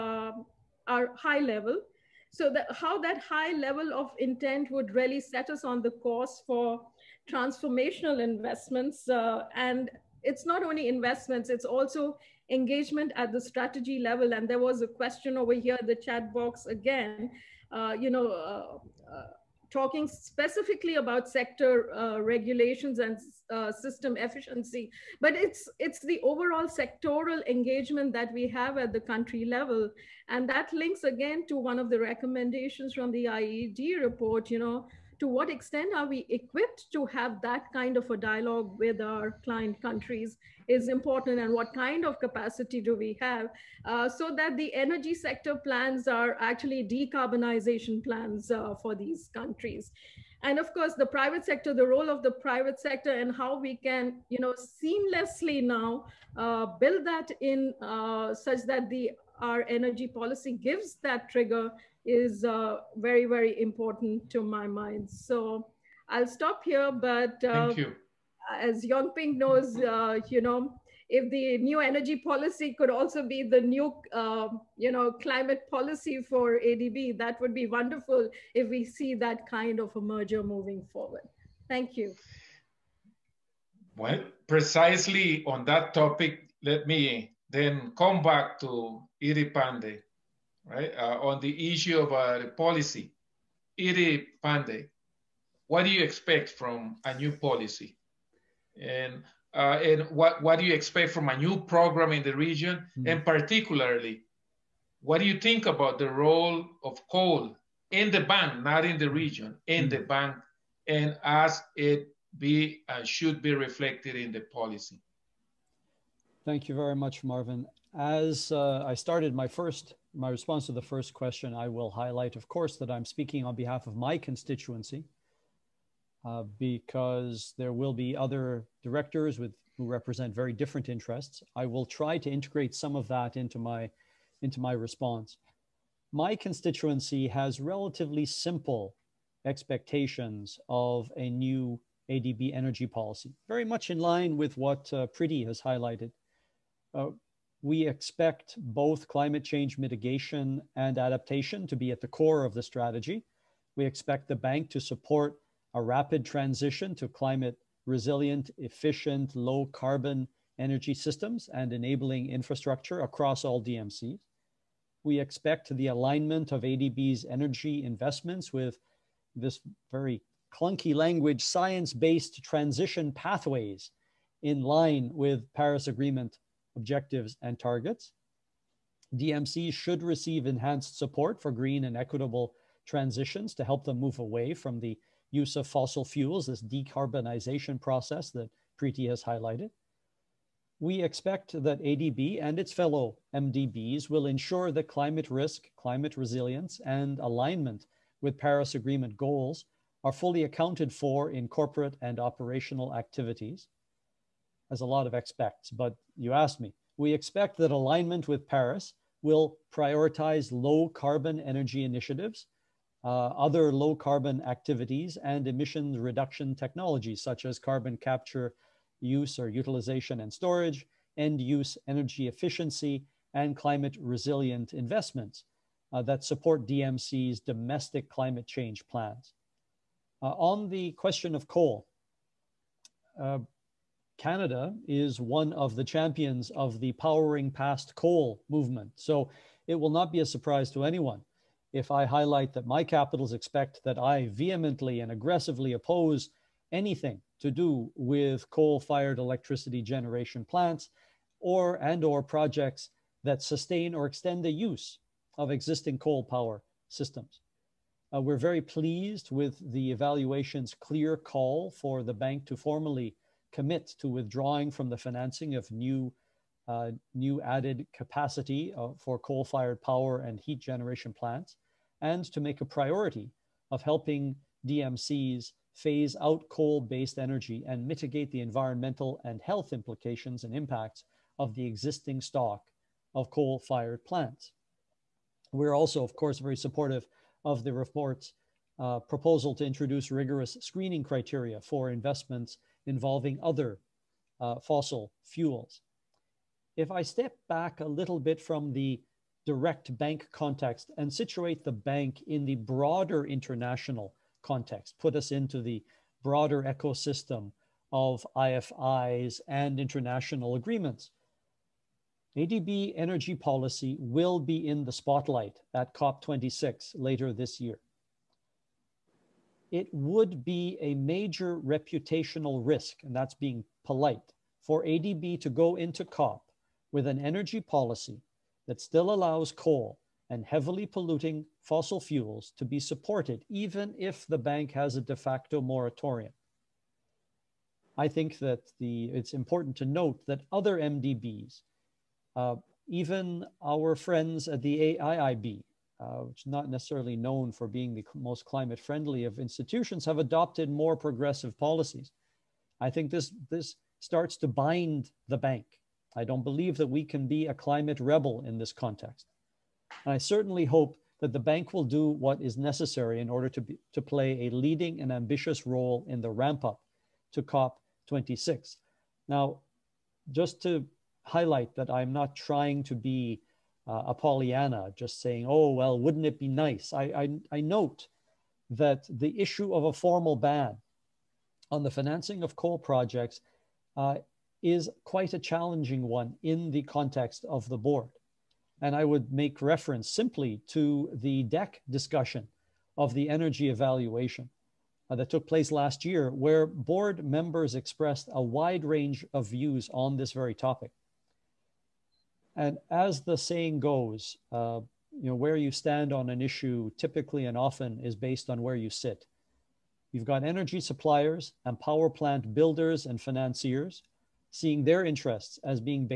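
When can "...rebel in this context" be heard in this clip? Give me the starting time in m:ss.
5:58.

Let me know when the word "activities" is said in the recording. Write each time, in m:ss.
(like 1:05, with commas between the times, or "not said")
3:22, 3:34.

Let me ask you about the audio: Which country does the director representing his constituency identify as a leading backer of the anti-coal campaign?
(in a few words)
Canada.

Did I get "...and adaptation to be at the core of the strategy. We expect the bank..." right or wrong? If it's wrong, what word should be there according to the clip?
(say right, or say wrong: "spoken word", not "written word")
right.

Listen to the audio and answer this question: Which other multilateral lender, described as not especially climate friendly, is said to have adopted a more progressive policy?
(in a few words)
AIIB.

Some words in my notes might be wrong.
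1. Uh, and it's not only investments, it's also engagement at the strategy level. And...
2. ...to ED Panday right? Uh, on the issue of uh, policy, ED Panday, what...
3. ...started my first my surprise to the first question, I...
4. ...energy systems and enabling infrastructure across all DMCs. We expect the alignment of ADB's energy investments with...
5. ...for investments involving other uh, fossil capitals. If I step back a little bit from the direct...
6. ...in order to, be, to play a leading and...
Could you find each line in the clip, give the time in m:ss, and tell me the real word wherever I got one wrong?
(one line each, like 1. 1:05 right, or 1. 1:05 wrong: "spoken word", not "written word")
1. 0:09 right
2. 1:28 right
3. 1:58 wrong: "response", not "surprise"
4. 2:40 right
5. 4:51 wrong: "fuels", not "capitals"
6. 6:03 right.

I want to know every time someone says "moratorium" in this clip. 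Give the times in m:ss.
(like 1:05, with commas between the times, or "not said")
5:35.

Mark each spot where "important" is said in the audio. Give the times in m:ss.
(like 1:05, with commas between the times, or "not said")
0:40, 1:03, 5:39.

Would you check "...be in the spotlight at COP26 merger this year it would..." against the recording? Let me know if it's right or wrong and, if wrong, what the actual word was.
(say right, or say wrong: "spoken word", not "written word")
wrong: "later", not "merger".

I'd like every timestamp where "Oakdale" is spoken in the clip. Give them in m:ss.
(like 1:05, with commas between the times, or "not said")
not said.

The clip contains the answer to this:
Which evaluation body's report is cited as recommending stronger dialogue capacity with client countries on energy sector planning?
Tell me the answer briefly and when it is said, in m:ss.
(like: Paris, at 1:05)
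IED, at 0:33.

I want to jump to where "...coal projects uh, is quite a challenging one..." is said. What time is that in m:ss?
6:22.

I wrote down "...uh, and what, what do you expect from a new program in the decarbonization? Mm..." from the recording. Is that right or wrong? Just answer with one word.
wrong.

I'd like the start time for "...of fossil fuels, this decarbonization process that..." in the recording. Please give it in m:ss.
3:05.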